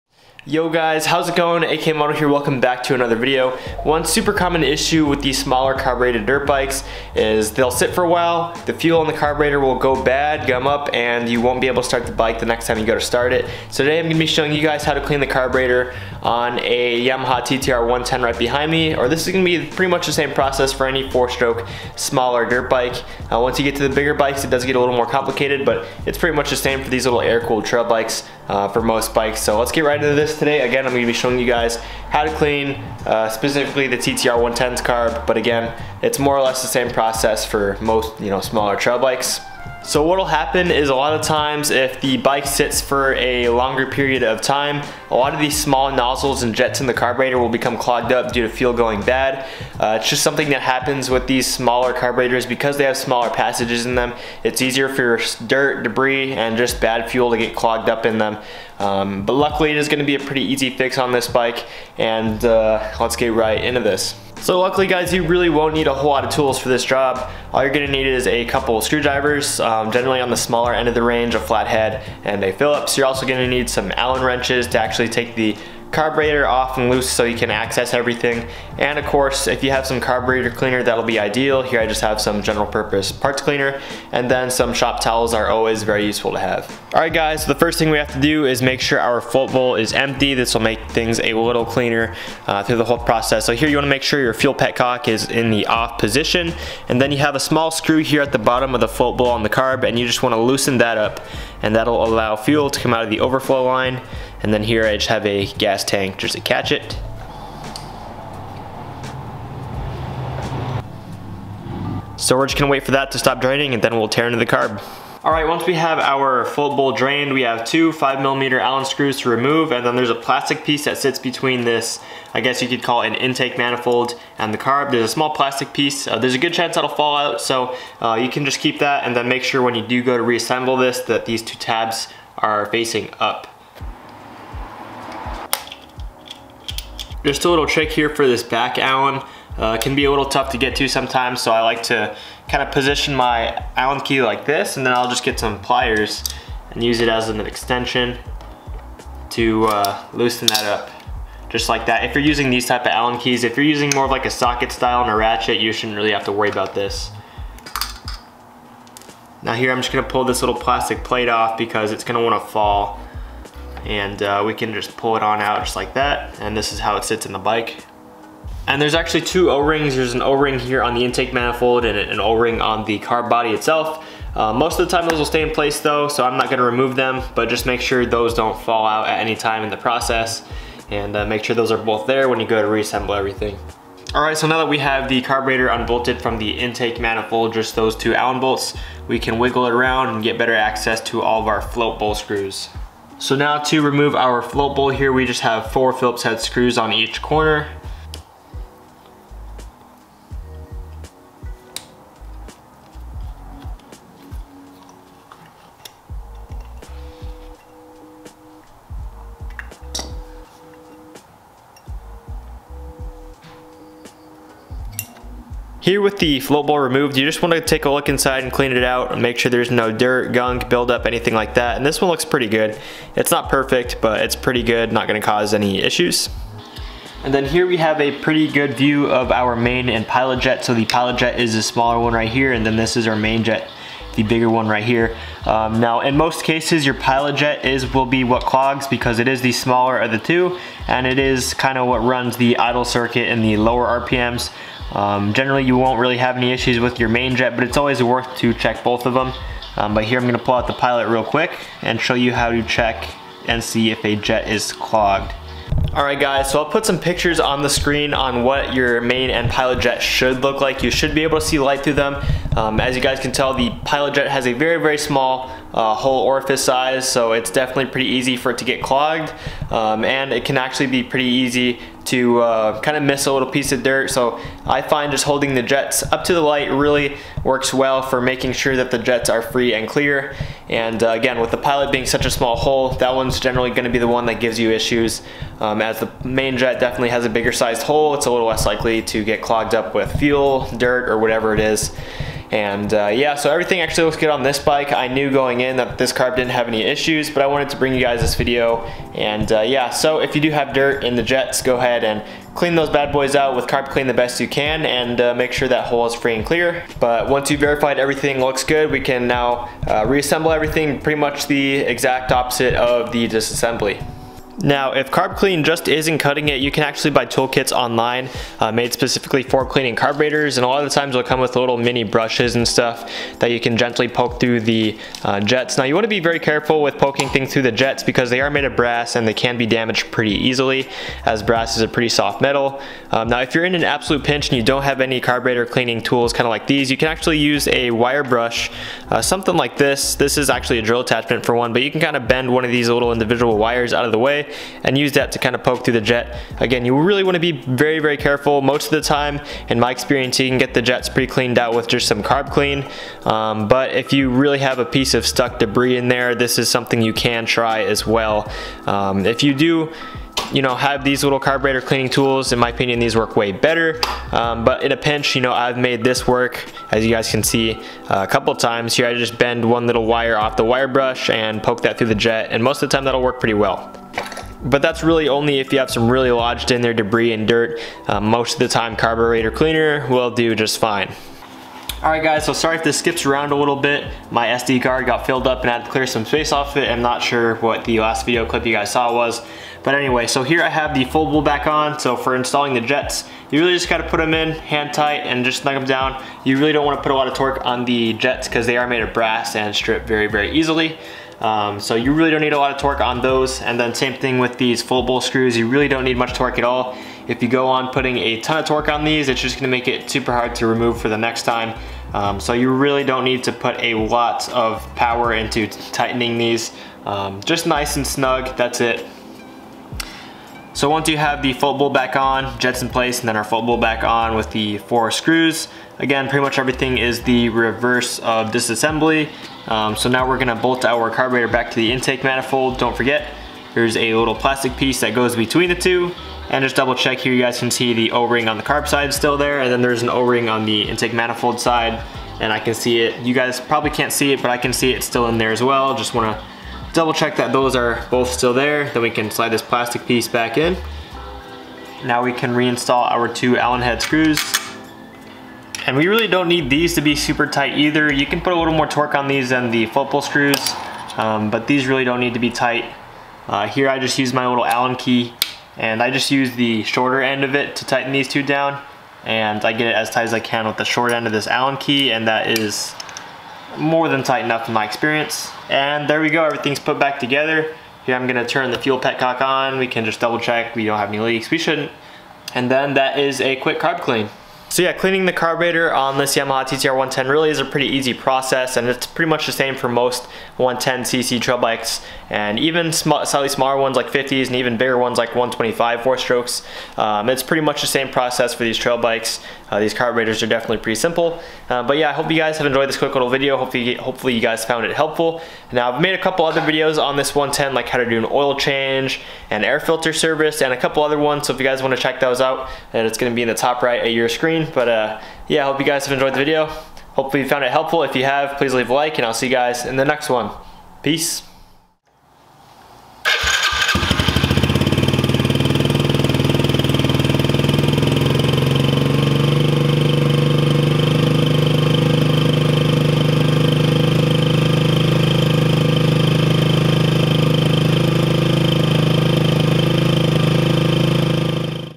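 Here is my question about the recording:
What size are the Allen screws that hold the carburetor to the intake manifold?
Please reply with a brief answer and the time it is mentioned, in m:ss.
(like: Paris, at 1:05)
5 millimeter, at 1:57.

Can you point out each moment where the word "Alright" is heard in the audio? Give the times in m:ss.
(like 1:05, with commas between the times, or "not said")
4:15, 6:22.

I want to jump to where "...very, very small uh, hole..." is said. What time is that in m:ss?
4:24.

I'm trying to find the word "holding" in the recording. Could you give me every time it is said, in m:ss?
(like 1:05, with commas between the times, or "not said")
4:35.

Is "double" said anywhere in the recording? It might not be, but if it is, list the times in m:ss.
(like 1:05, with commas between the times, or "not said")
7:16, 7:26, 8:00.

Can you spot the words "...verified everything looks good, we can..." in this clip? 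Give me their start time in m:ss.
5:07.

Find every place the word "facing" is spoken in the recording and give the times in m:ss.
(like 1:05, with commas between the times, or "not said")
2:12.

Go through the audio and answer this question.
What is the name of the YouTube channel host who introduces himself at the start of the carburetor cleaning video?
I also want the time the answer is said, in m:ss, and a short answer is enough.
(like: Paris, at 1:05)
AKMoto, at 0:01.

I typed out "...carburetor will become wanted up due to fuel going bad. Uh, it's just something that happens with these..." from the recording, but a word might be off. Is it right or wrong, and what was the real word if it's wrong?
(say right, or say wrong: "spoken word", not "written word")
wrong: "clogged", not "wanted".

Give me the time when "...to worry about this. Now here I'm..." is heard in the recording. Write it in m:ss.
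2:36.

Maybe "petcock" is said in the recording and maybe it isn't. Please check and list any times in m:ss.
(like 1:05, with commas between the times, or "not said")
1:34, 7:58.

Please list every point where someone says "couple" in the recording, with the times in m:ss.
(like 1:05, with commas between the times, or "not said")
1:08, 6:08, 8:26, 8:30.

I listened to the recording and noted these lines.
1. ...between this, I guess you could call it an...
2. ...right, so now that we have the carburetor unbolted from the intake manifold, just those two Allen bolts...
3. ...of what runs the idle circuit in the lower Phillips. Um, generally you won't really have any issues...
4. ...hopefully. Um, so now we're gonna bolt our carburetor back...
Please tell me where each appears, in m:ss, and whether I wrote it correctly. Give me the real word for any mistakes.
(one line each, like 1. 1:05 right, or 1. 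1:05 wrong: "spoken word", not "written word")
1. 2:01 right
2. 3:04 right
3. 4:01 wrong: "RPMs", not "Phillips"
4. 7:08 wrong: "disassembly", not "hopefully".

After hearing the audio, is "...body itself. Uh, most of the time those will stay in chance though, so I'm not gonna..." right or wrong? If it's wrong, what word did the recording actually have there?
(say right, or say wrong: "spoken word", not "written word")
wrong: "place", not "chance".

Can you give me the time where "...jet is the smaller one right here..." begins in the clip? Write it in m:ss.
3:51.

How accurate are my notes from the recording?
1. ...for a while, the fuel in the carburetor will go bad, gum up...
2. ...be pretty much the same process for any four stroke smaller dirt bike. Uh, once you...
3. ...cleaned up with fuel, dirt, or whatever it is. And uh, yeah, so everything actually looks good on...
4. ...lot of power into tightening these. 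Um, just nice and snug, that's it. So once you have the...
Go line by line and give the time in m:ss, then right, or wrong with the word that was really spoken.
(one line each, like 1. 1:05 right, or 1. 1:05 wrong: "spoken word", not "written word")
1. 0:07 right
2. 0:19 right
3. 4:49 wrong: "clogged", not "cleaned"
4. 6:53 right.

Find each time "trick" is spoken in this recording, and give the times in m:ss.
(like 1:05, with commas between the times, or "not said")
2:17.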